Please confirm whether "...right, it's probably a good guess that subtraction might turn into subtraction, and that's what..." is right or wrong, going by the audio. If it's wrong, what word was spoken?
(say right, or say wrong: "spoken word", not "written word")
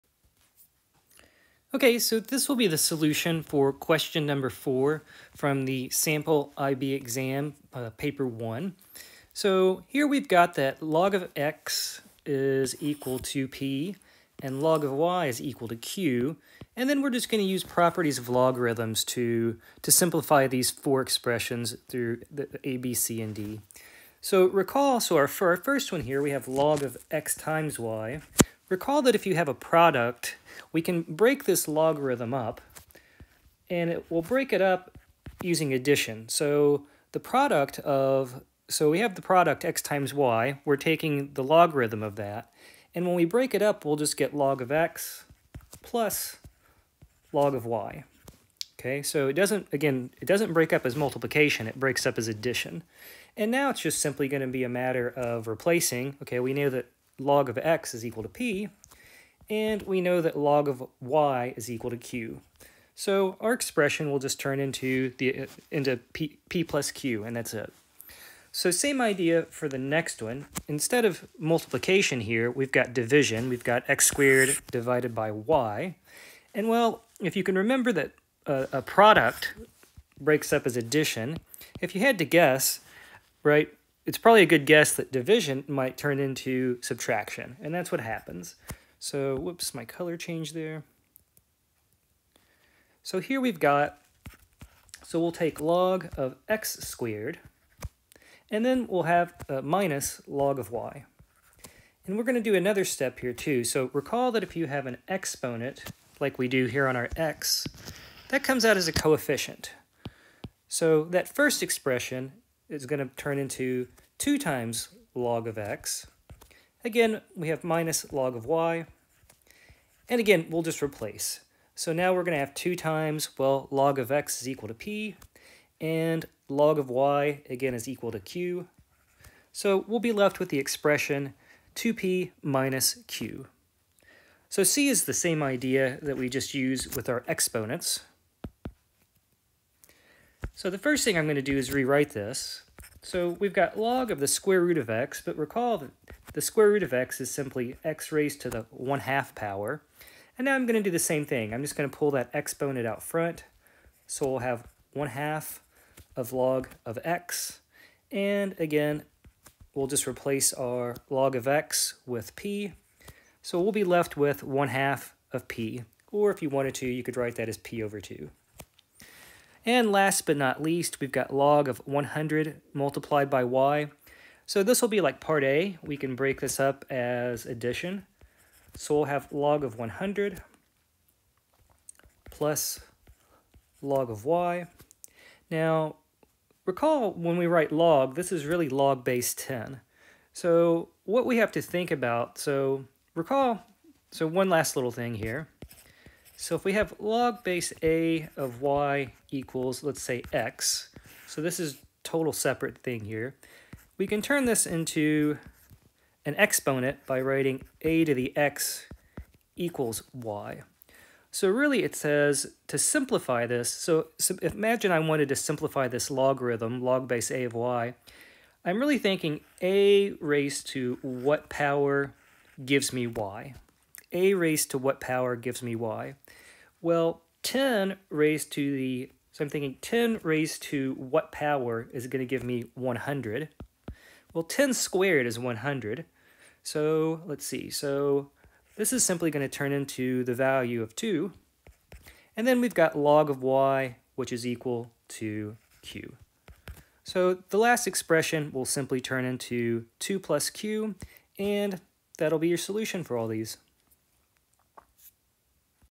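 wrong: "division", not "subtraction".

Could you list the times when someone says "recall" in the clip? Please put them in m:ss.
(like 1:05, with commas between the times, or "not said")
0:24, 0:28, 1:43, 2:25, 3:06, 3:13.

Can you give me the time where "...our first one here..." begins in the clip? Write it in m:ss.
0:25.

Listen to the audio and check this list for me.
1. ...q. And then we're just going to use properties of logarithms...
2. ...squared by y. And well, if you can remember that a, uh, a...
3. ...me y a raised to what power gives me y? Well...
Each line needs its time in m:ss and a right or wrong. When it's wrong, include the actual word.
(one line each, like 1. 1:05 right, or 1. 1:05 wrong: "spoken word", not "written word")
1. 0:15 right
2. 1:14 wrong: "divided", not "squared"
3. 3:42 right.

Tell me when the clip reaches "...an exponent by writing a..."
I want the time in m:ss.
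3:26.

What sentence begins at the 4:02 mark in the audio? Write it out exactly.
And then we've got log of y, which is equal to q.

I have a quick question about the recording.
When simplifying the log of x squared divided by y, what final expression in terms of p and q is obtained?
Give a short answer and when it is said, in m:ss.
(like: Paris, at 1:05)
2p minus q, at 2:11.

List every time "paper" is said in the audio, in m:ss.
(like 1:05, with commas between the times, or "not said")
0:07.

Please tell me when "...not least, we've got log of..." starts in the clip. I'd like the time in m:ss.
2:50.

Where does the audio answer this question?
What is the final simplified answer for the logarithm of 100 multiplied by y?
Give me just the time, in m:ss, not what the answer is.
4:09.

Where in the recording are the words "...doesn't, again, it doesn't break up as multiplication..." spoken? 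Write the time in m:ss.
0:49.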